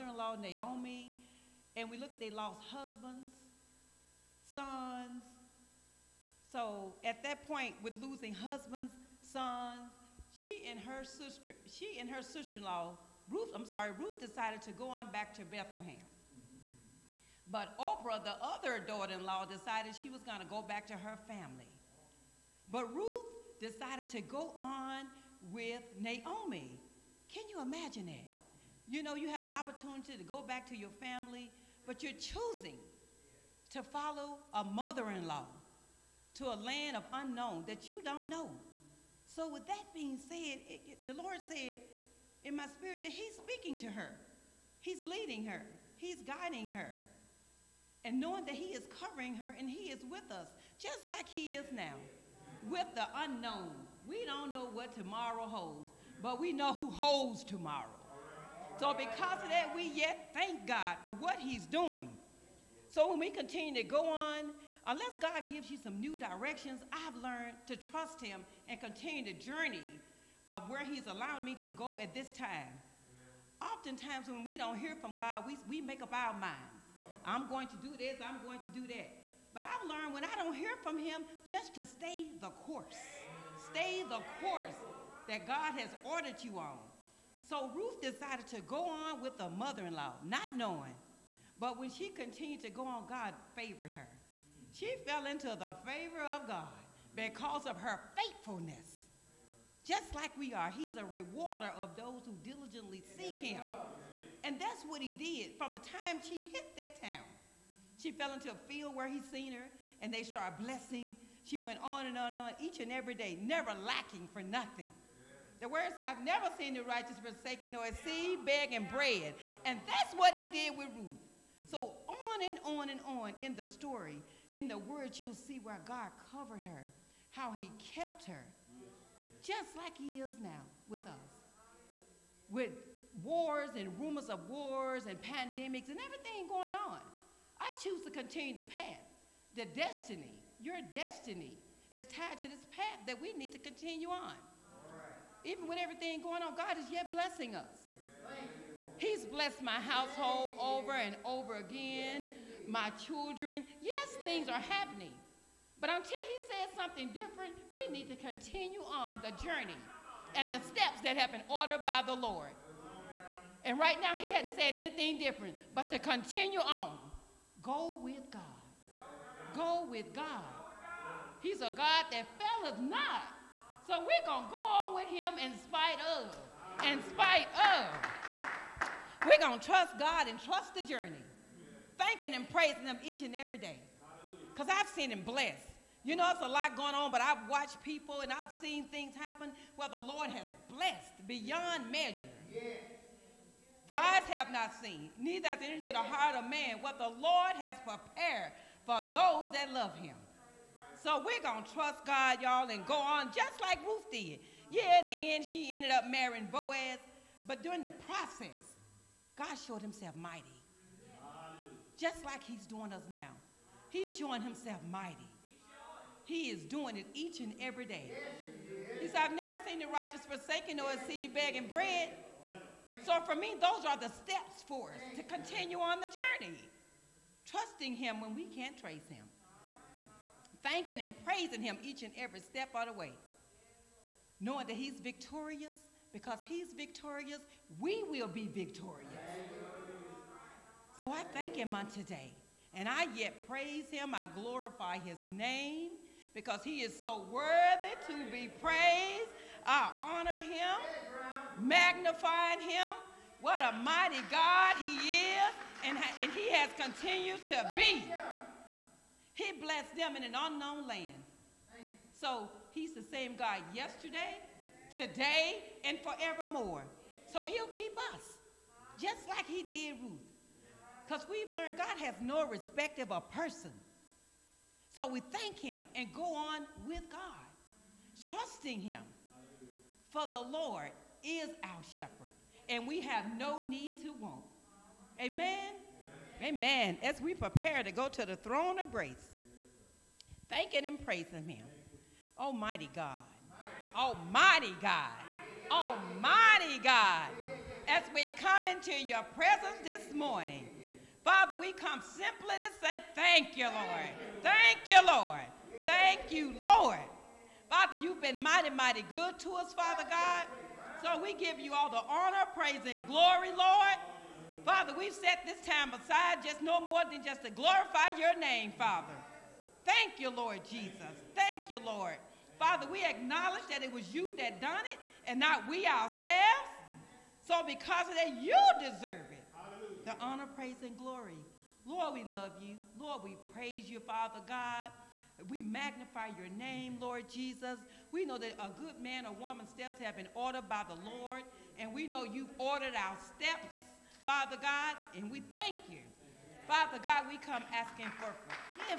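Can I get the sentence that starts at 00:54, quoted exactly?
We don't know what tomorrow holds, but we know who holds tomorrow.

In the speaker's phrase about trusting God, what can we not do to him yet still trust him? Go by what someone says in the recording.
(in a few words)
trace him.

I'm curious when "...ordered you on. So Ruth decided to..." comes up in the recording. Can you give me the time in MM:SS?
01:26.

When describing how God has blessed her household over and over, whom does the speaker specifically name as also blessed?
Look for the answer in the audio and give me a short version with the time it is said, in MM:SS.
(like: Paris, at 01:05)
my children, at 02:32.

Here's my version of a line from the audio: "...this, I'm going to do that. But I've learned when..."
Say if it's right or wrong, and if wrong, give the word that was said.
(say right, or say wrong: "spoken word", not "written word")
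right.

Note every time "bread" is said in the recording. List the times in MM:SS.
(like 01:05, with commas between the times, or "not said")
01:58, 03:41.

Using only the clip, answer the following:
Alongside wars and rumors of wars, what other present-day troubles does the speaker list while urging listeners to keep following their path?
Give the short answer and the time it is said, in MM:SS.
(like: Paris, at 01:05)
pandemics, at 02:15.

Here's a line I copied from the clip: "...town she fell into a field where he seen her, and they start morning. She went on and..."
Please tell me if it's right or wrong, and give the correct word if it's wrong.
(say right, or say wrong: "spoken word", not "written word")
wrong: "blessing", not "morning".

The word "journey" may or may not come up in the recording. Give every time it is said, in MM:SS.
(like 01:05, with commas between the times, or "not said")
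01:09, 02:39, 03:00, 03:46.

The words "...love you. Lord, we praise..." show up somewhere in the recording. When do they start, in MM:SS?
05:32.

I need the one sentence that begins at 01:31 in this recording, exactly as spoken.
But when she continued to go on, God favored her.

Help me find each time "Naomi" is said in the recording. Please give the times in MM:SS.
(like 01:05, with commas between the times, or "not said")
00:00, 00:25.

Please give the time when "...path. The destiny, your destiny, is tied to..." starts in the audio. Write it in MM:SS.
02:18.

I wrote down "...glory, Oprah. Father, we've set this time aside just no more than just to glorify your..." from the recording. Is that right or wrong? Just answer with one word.
wrong.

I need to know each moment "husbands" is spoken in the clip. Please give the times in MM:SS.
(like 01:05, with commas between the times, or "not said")
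00:02, 00:08.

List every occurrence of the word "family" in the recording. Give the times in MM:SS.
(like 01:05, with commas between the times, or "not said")
00:21, 00:30.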